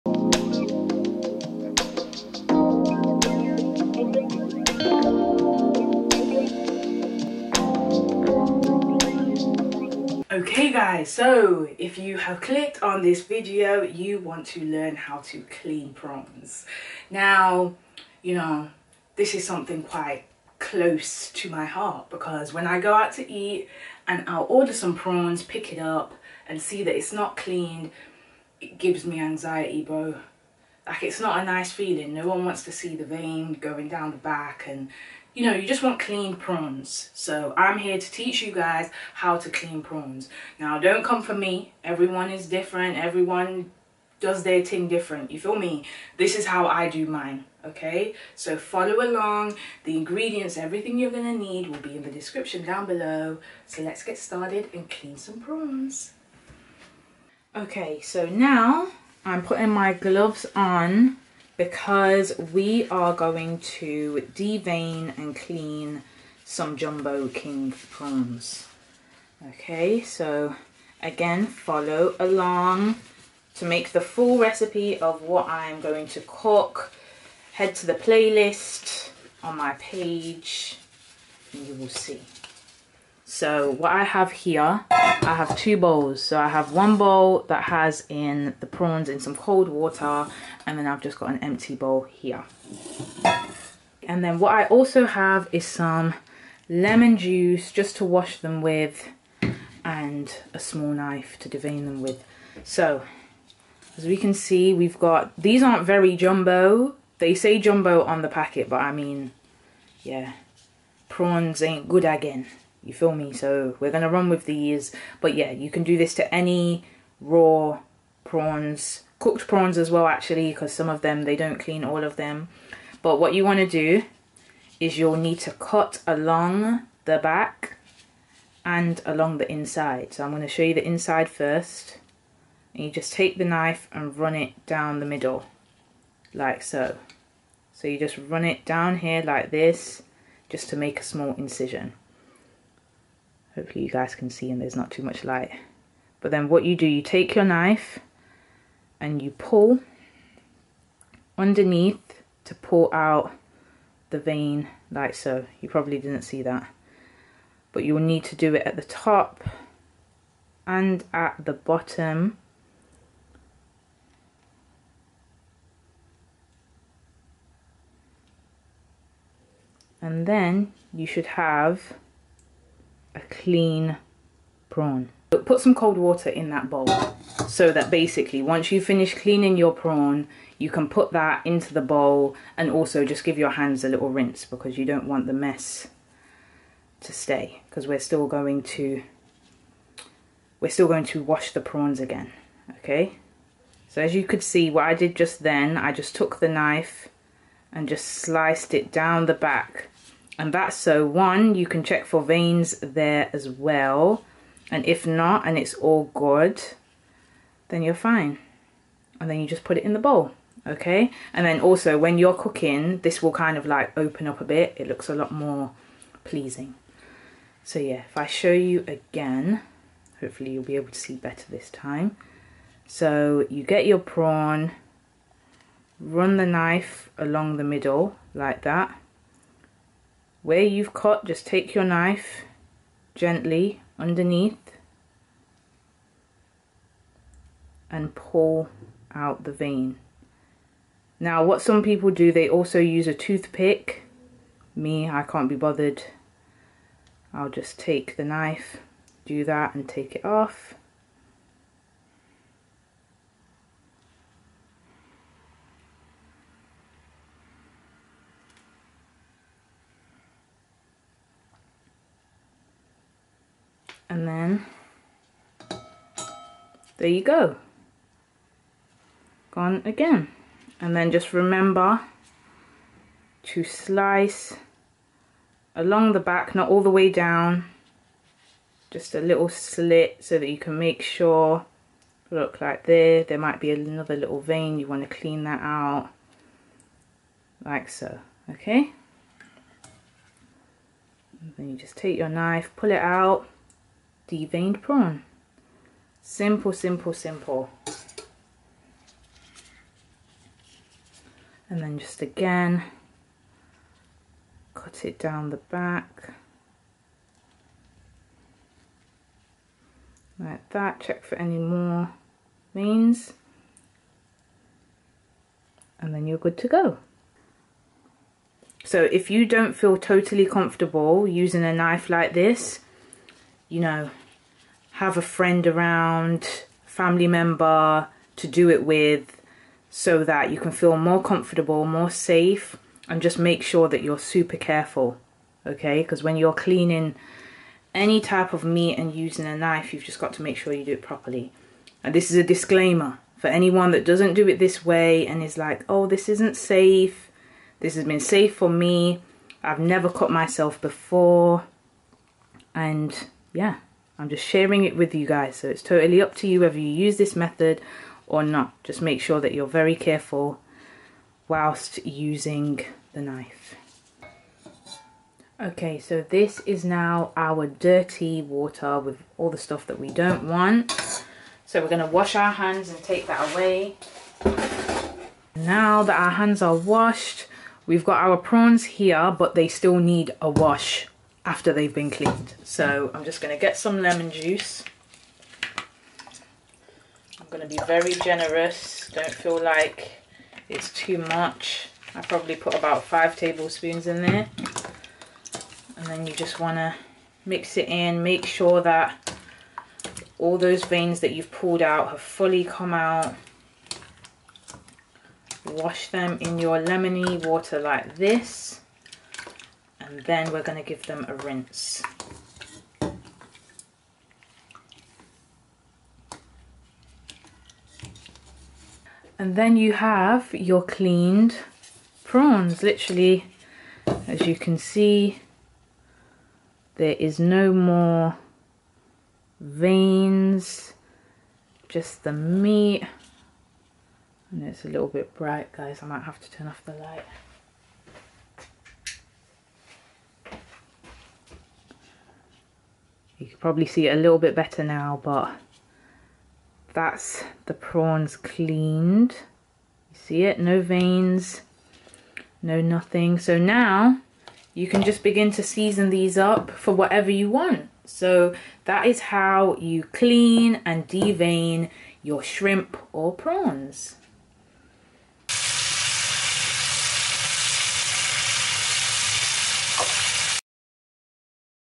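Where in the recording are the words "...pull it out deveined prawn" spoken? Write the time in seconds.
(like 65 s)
292 s.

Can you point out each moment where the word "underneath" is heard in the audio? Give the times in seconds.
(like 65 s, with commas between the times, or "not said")
151 s, 233 s.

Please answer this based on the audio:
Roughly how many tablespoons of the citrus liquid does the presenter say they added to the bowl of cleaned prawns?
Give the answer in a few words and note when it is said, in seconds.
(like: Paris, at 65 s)
5, at 393 s.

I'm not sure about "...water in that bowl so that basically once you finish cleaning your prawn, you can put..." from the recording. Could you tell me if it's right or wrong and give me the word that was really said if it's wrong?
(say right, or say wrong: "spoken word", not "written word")
right.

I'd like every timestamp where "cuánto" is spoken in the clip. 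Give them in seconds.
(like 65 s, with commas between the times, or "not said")
not said.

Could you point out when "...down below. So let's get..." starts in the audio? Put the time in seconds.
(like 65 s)
52 s.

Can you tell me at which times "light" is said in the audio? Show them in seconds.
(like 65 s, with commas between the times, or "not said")
145 s, 436 s.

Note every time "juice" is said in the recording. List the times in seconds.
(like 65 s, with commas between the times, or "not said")
97 s, 384 s.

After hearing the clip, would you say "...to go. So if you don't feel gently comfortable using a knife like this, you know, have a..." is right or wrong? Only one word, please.
wrong.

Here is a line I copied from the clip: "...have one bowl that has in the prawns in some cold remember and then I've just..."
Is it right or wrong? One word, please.
wrong.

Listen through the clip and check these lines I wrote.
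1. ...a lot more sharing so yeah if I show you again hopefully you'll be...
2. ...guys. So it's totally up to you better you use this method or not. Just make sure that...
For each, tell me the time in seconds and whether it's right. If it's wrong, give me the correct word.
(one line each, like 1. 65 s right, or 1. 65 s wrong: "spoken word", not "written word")
1. 215 s wrong: "pleasing", not "sharing"
2. 355 s wrong: "whether", not "better".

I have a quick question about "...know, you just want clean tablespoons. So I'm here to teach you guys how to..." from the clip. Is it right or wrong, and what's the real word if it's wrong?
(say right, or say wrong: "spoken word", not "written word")
wrong: "prawns", not "tablespoons".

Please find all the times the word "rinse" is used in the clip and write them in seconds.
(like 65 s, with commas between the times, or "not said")
184 s, 411 s.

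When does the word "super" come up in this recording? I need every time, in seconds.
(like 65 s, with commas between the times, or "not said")
334 s.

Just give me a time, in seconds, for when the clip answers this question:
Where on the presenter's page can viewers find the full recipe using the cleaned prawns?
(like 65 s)
77 s.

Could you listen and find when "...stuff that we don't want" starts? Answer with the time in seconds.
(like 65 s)
369 s.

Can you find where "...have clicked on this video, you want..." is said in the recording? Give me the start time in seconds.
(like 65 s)
12 s.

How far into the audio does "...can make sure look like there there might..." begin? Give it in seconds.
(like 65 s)
280 s.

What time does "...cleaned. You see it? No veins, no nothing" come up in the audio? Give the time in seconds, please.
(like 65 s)
448 s.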